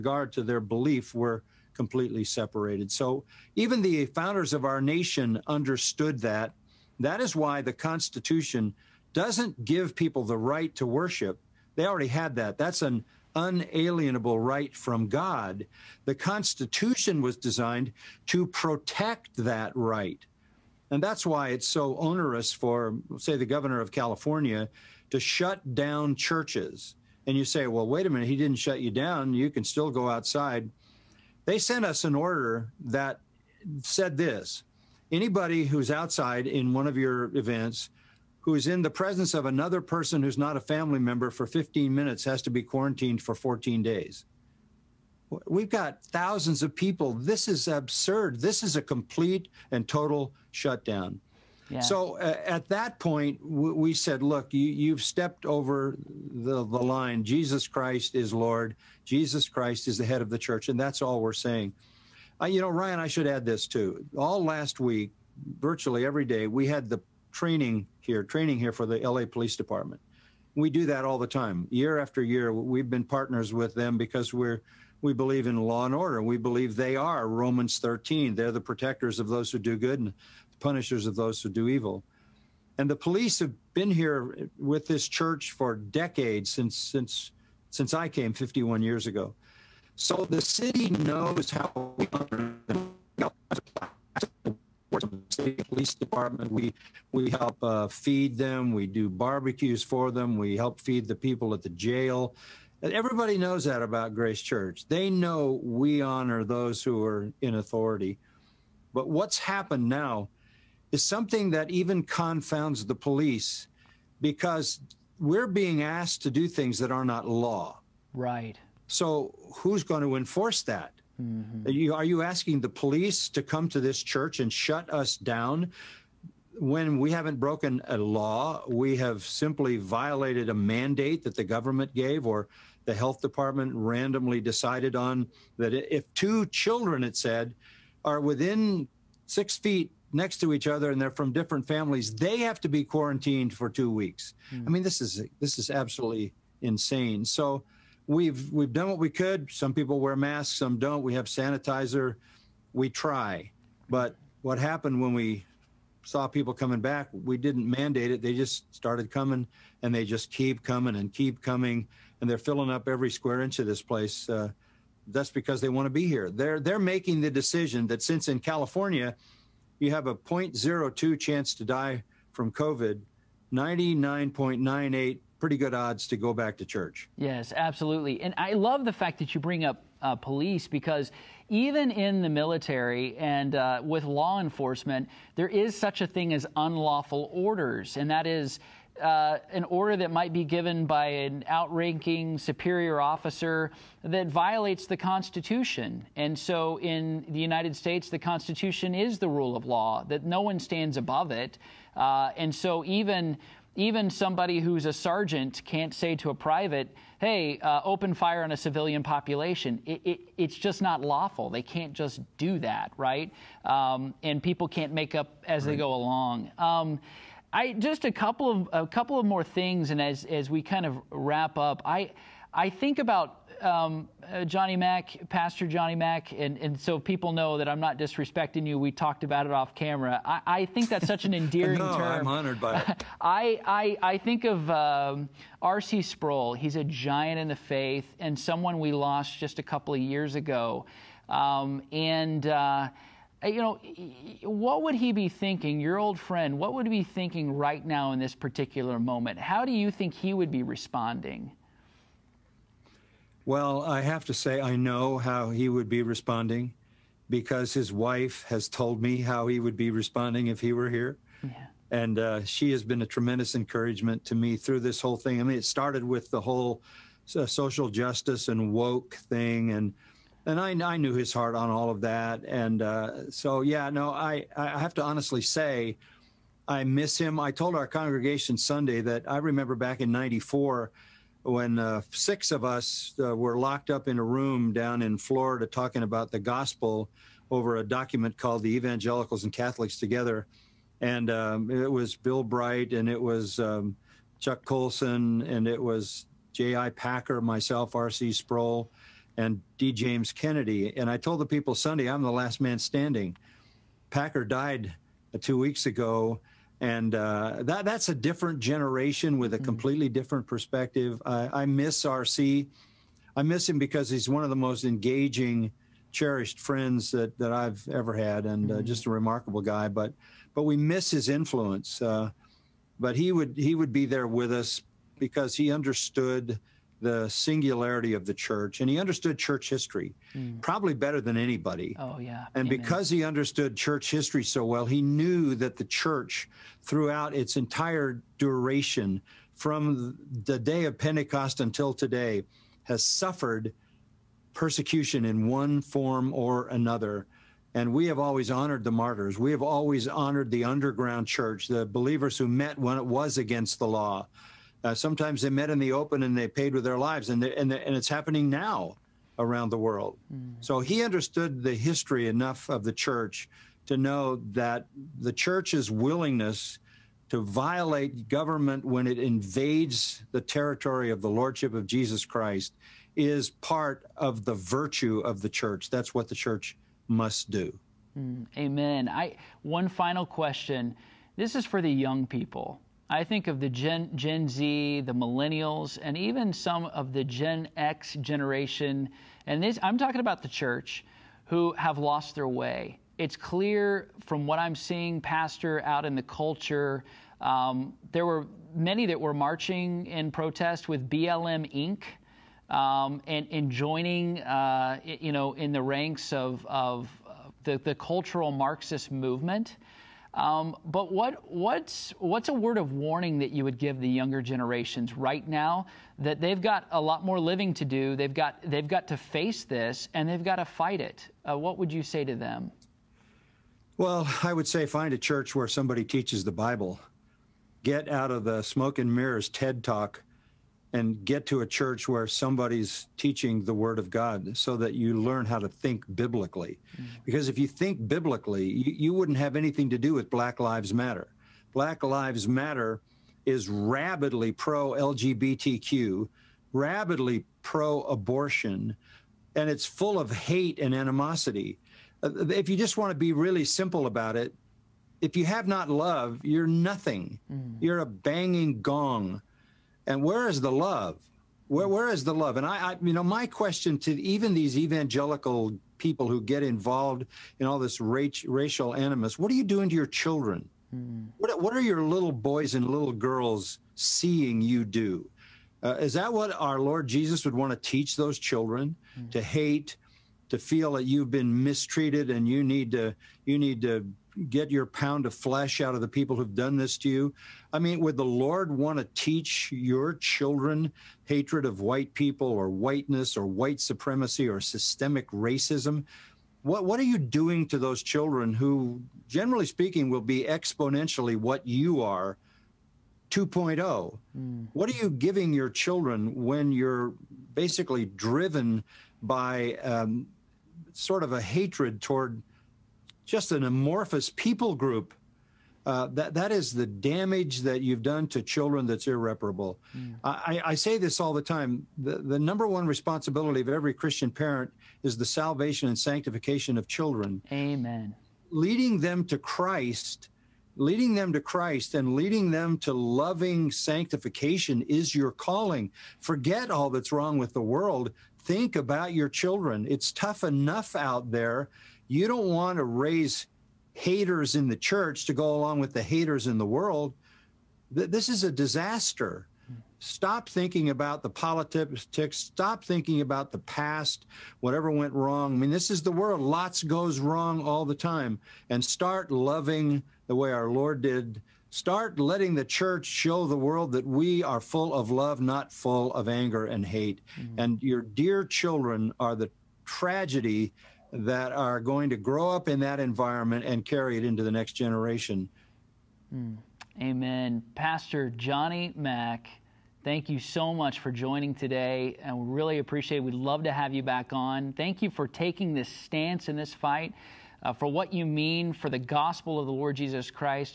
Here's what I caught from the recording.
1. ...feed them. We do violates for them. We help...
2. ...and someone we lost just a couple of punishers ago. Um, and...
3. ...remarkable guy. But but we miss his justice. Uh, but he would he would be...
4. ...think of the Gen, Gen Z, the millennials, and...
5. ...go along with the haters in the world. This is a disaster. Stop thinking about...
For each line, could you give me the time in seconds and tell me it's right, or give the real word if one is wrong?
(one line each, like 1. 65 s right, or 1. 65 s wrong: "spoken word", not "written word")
1. 97 s wrong: "barbecues", not "violates"
2. 238 s wrong: "years", not "punishers"
3. 319 s wrong: "influence", not "justice"
4. 383 s right
5. 545 s right.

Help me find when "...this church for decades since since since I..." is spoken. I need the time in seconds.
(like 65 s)
84 s.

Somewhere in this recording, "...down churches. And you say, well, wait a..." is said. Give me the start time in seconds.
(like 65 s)
25 s.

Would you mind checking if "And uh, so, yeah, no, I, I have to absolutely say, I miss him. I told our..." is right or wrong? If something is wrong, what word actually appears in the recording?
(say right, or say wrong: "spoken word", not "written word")
wrong: "honestly", not "absolutely".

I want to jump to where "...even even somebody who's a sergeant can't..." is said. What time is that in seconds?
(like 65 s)
202 s.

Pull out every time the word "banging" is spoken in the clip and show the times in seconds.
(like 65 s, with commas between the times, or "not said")
458 s.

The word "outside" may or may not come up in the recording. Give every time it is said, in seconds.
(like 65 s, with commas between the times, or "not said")
30 s, 35 s.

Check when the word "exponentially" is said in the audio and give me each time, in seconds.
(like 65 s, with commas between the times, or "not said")
500 s.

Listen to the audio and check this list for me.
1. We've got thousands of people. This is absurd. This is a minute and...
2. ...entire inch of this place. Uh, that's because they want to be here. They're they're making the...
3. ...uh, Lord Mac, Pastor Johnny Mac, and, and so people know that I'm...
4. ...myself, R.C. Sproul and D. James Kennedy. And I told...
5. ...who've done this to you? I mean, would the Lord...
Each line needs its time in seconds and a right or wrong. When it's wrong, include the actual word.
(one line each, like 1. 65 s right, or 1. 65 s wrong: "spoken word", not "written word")
1. 45 s wrong: "complete", not "minute"
2. 163 s wrong: "square", not "entire"
3. 224 s wrong: "Johnny", not "Lord"
4. 297 s right
5. 486 s right.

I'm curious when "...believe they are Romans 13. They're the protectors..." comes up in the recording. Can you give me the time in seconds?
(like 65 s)
76 s.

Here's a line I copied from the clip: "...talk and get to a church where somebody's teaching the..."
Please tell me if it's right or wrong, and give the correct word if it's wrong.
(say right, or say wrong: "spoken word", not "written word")
right.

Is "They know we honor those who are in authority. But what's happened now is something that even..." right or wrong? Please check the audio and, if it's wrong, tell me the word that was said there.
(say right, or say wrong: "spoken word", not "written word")
right.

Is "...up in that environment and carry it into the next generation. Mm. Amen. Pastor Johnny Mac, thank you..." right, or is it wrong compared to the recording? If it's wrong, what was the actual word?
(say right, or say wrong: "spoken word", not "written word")
right.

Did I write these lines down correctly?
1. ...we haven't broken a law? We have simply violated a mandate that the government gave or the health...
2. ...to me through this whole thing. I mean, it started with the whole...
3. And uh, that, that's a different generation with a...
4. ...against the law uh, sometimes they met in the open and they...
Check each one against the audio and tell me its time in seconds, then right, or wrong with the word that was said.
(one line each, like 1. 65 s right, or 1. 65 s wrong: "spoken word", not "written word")
1. 126 s right
2. 264 s right
3. 306 s right
4. 353 s right.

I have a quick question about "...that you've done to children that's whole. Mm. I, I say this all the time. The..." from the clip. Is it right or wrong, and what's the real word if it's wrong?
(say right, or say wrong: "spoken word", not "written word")
wrong: "irreparable", not "whole".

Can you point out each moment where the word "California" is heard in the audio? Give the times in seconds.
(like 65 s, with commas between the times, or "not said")
23 s, 168 s.